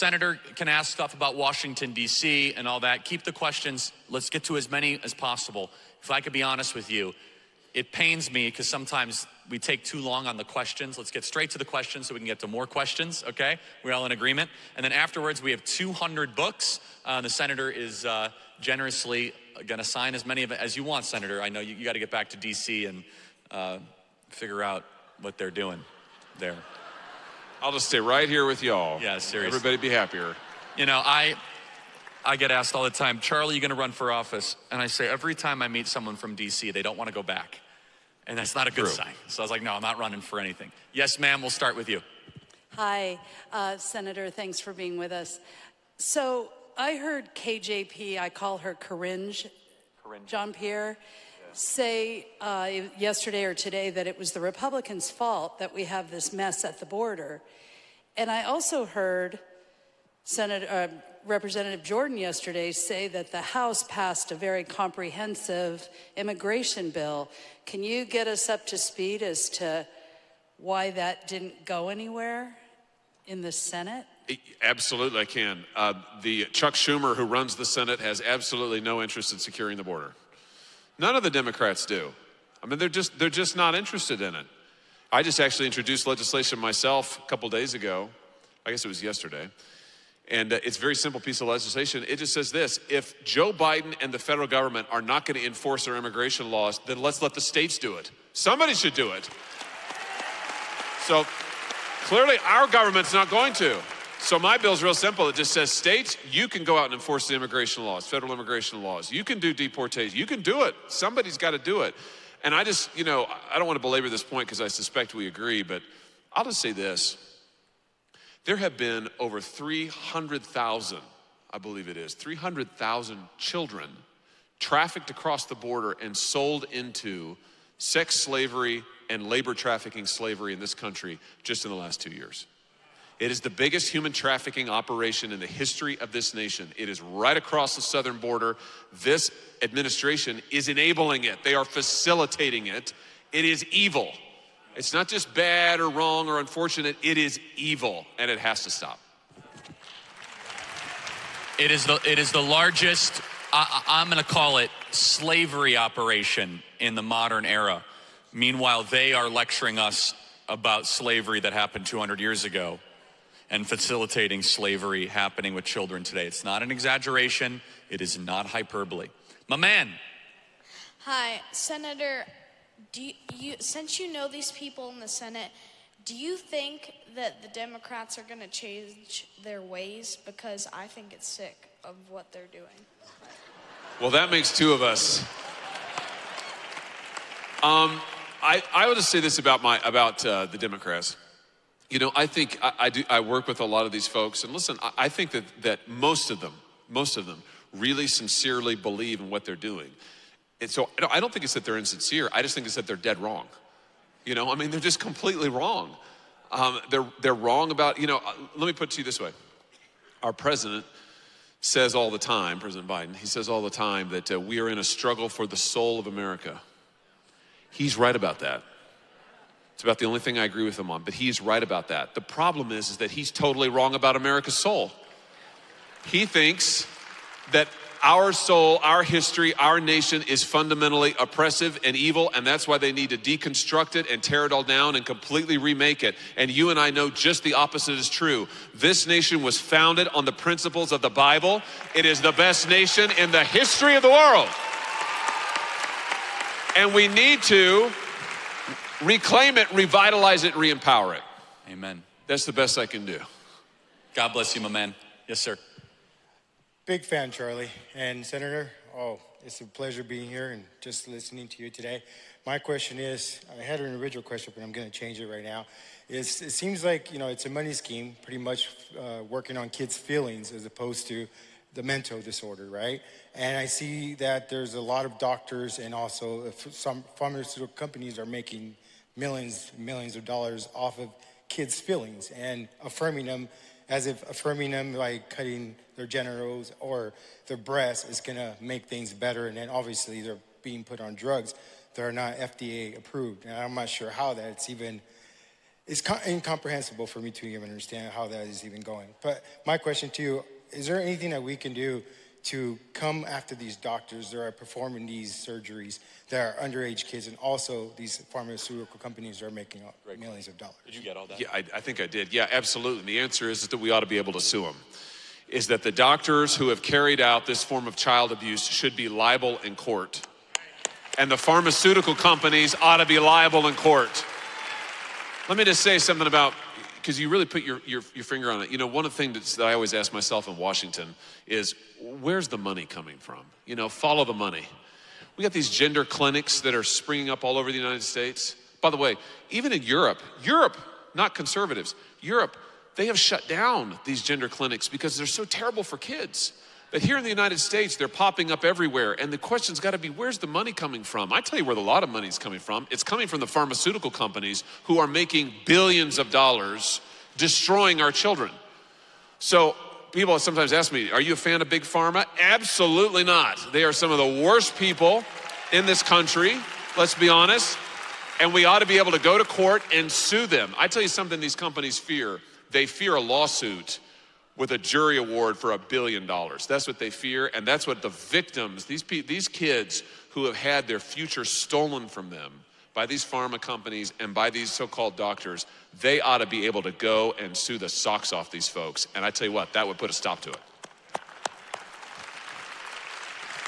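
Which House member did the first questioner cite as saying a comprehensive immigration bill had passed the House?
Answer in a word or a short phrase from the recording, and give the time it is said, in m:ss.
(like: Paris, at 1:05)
Jordan, at 1:01.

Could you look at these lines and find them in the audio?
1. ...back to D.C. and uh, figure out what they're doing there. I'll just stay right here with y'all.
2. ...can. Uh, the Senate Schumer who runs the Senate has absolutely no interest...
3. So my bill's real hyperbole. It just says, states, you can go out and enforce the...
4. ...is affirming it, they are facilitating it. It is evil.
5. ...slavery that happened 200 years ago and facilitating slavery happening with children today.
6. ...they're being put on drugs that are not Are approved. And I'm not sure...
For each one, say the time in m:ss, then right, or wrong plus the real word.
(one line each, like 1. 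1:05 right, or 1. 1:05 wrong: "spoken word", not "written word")
1. 0:22 right
2. 1:15 wrong: "Chuck", not "Senate"
3. 1:44 wrong: "simple", not "hyperbole"
4. 2:20 wrong: "enabling", not "affirming"
5. 2:40 right
6. 4:50 wrong: "FDA", not "Are".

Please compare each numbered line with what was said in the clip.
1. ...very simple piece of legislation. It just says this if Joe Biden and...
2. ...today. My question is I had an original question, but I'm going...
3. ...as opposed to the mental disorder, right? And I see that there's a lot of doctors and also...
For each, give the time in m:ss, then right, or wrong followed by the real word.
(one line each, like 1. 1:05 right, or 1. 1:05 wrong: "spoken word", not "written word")
1. 1:30 right
2. 4:21 right
3. 4:30 right.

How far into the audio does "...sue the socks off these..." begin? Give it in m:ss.
6:27.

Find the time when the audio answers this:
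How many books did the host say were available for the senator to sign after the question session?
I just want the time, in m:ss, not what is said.
0:15.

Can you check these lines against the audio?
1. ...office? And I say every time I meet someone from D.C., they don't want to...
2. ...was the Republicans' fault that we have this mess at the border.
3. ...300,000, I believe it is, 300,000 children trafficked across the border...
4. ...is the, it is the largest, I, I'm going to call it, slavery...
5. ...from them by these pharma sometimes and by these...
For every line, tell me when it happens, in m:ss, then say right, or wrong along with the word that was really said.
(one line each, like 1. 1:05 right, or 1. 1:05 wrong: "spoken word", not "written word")
1. 0:34 right
2. 0:54 right
3. 1:59 right
4. 2:31 right
5. 6:22 wrong: "companies", not "sometimes".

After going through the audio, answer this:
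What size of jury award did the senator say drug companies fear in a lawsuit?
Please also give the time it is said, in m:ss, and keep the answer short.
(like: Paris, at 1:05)
a billion dollars, at 6:15.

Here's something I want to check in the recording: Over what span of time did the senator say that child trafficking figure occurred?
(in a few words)
the last two years.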